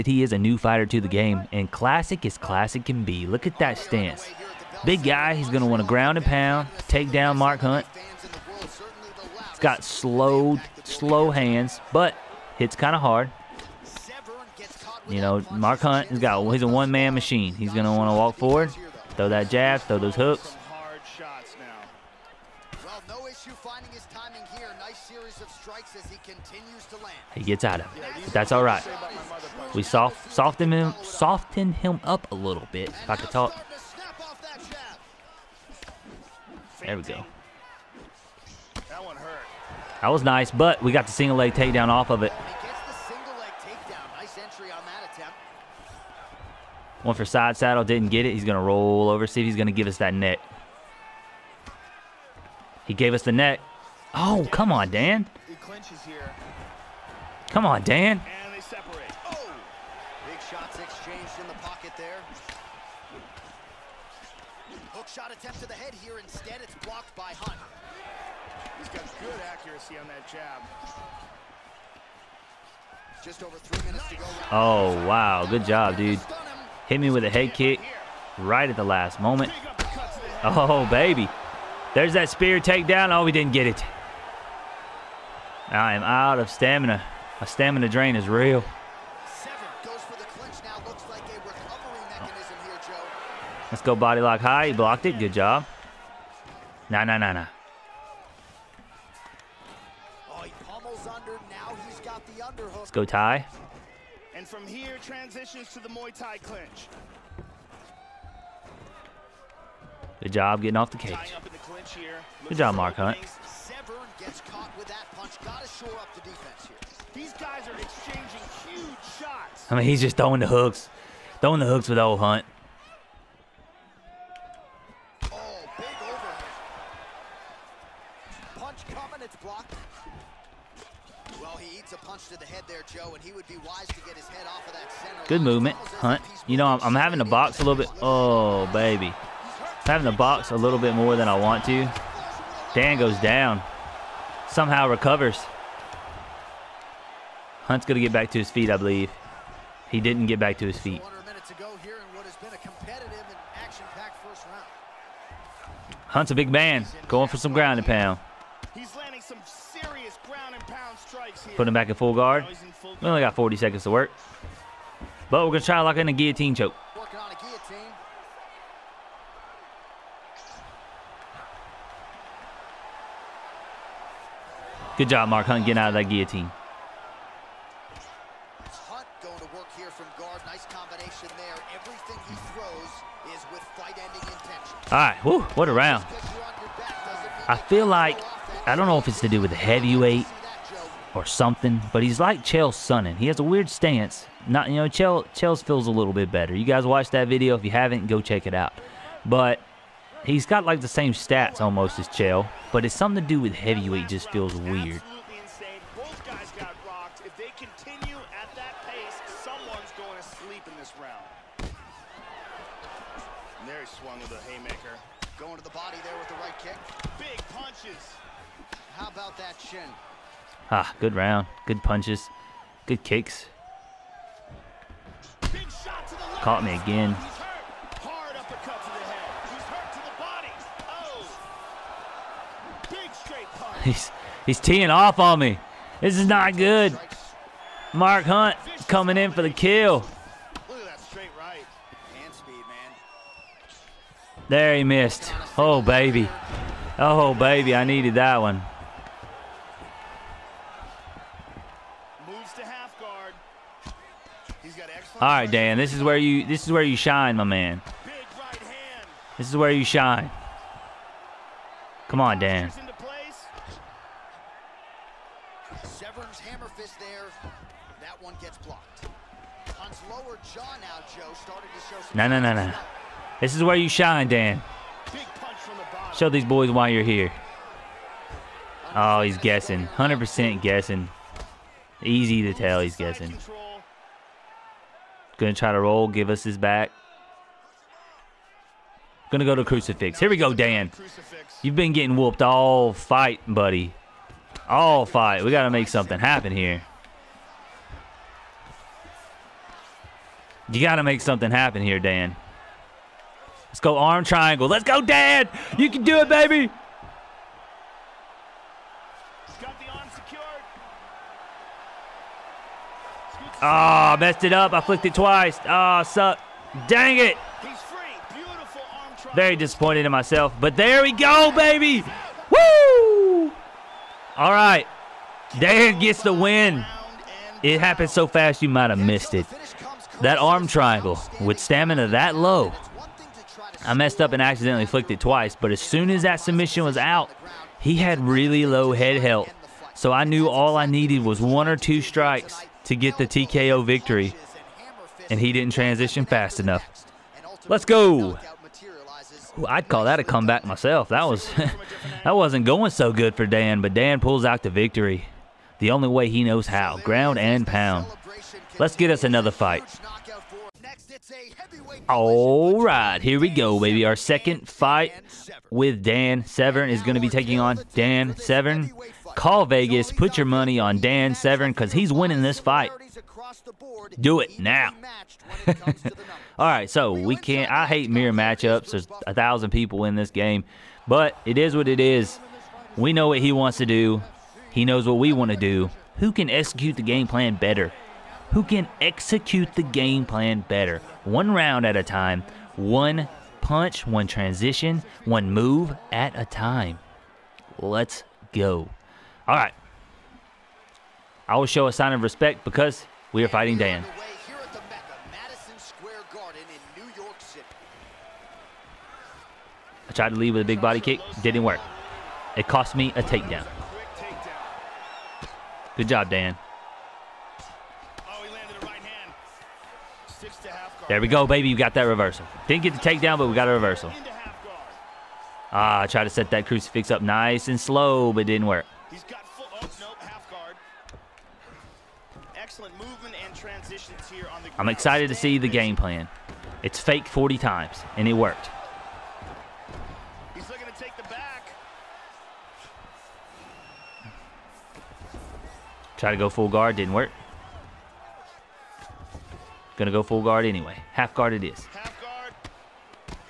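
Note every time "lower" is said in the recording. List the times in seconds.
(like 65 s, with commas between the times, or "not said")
270 s.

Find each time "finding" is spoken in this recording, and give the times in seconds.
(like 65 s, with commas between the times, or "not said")
23 s.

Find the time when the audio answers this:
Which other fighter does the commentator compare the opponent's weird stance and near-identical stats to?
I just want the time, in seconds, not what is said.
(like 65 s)
192 s.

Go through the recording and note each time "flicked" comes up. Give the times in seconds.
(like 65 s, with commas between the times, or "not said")
314 s, 334 s.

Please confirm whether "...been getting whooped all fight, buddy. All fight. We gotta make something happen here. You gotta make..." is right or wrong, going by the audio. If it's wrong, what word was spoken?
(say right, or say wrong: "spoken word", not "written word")
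right.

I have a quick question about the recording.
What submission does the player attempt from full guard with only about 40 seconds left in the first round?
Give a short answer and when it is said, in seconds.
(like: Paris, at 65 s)
guillotine choke, at 166 s.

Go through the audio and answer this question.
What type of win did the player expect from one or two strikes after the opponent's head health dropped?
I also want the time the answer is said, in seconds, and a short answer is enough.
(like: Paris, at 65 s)
TKO, at 343 s.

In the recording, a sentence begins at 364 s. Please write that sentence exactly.
Our second fight with Dan Severn is going to be taking on Dan Severn Call Vegas.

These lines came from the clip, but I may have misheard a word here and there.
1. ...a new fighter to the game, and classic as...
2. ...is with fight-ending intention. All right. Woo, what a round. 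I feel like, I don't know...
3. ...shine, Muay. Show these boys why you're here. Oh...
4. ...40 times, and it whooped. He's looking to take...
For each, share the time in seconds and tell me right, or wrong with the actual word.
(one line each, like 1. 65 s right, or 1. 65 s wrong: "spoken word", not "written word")
1. 0 s right
2. 183 s right
3. 273 s wrong: "Dan", not "Muay"
4. 437 s wrong: "worked", not "whooped".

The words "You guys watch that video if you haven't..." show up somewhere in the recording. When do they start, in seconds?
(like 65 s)
196 s.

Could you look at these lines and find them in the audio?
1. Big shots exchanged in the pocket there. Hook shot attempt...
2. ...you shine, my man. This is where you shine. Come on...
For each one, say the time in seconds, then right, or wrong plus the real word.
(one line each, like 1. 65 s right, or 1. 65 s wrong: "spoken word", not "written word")
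1. 60 s right
2. 256 s right.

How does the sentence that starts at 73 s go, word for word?
Just over three minutes to go.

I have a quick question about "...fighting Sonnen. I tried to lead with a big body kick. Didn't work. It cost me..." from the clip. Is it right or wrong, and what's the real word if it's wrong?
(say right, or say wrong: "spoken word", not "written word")
wrong: "Dan", not "Sonnen".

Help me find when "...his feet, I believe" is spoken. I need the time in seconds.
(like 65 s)
148 s.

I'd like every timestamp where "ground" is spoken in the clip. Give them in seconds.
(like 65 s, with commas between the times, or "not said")
5 s, 157 s, 356 s, 434 s.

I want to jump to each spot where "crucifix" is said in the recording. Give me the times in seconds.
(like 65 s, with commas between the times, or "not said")
289 s, 426 s.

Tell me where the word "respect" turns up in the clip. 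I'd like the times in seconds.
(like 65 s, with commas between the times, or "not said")
402 s.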